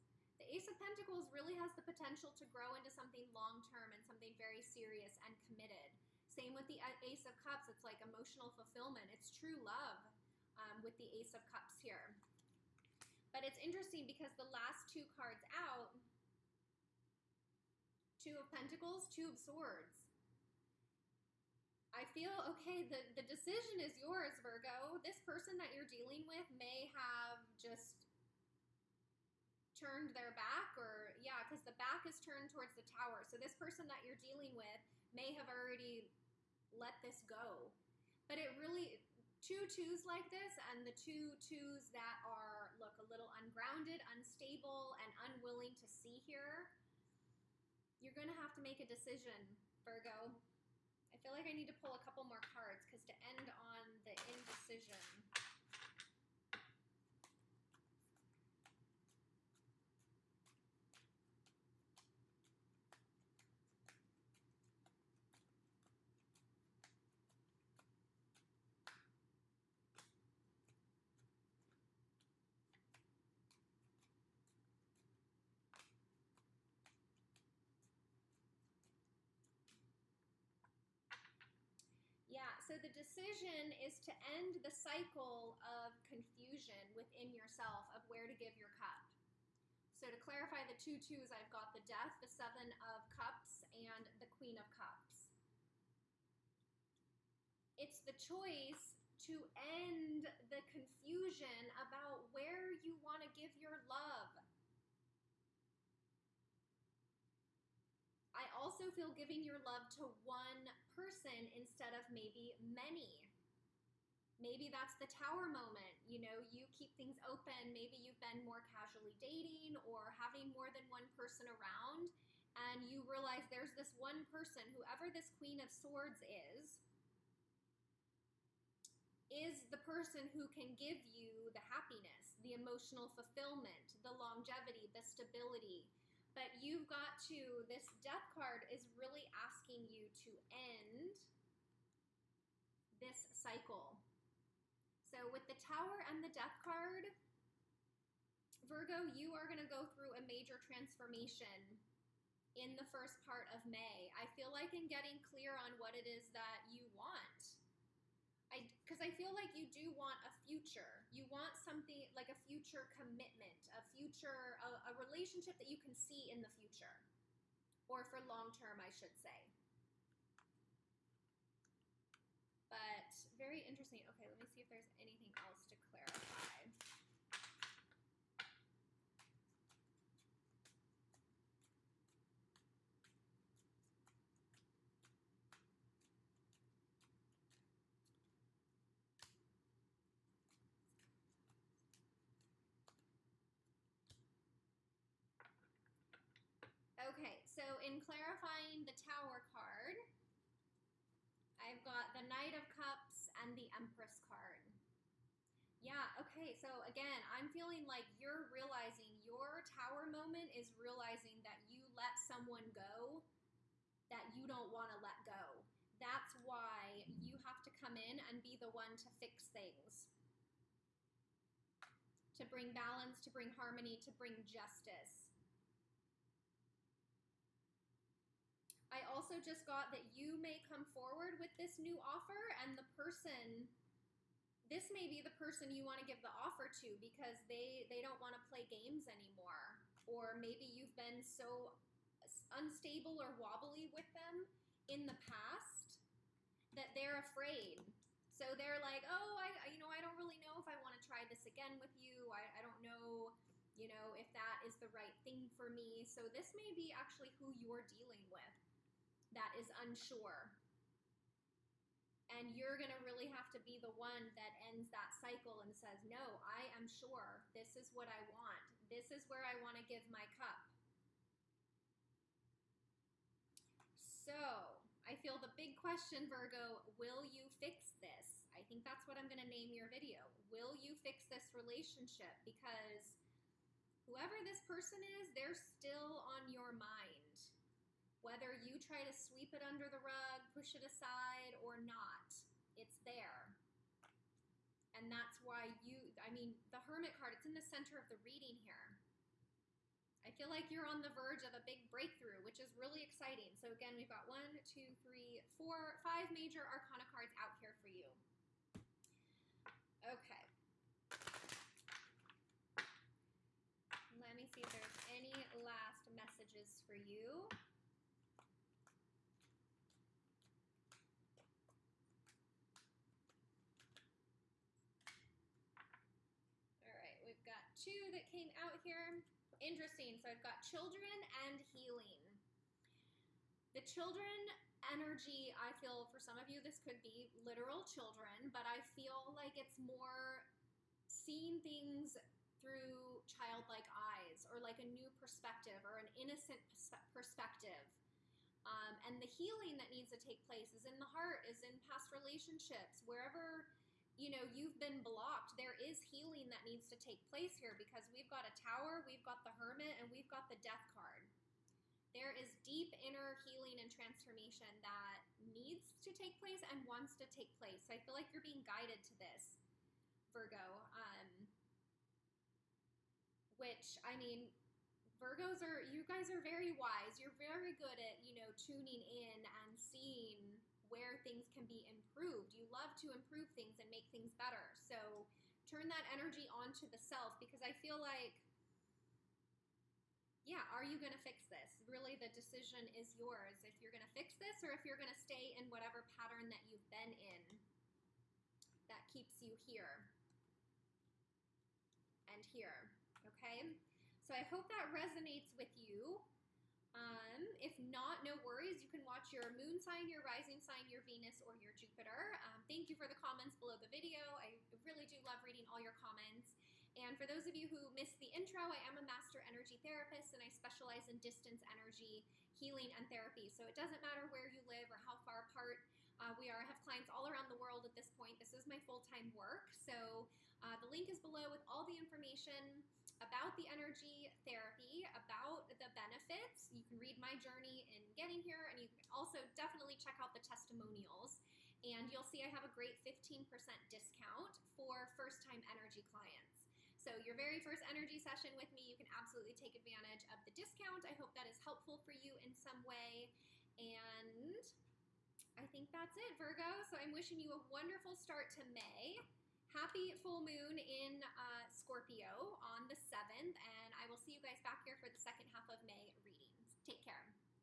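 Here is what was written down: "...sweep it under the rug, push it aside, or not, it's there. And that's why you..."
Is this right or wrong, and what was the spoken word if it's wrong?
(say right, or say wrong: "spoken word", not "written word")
right.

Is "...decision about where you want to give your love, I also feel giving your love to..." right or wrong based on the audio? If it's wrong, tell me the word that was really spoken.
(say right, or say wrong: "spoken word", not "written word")
wrong: "confusion", not "decision".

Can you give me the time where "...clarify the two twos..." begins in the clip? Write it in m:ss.
1:30.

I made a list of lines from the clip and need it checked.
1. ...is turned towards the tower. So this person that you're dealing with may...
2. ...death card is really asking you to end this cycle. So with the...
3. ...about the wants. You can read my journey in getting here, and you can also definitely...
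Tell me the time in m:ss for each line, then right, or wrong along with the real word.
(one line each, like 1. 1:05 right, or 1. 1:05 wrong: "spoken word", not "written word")
1. 0:32 right
2. 2:17 right
3. 7:15 wrong: "benefits", not "wants".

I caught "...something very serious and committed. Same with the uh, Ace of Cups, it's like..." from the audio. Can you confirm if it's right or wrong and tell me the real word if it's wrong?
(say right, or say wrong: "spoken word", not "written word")
right.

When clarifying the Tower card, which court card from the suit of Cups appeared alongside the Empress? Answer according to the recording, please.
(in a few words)
Knight of Cups.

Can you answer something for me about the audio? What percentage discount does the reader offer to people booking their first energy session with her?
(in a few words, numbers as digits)
15%.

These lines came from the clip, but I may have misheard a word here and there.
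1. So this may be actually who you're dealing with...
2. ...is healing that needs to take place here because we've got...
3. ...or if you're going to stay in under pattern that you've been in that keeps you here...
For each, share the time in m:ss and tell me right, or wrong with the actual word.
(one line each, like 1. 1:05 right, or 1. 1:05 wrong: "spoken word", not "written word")
1. 4:16 right
2. 5:55 right
3. 6:34 wrong: "whatever", not "under".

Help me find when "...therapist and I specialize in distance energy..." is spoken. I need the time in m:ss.
6:59.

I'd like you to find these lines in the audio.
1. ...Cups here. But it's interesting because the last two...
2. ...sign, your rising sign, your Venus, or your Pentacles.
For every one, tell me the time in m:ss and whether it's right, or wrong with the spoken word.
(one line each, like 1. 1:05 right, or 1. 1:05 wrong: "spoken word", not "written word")
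1. 0:11 right
2. 6:49 wrong: "Jupiter", not "Pentacles".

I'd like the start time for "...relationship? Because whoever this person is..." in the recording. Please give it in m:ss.
4:41.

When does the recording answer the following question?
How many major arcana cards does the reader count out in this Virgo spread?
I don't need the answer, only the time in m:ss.
5:06.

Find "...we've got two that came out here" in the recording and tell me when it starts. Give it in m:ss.
5:27.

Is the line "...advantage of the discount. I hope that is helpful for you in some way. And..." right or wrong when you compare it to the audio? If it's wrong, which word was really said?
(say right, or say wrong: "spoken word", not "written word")
right.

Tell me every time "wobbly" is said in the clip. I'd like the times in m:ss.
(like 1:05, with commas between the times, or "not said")
4:03.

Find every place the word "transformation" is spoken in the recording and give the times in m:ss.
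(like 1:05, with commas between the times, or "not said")
2:30, 6:03.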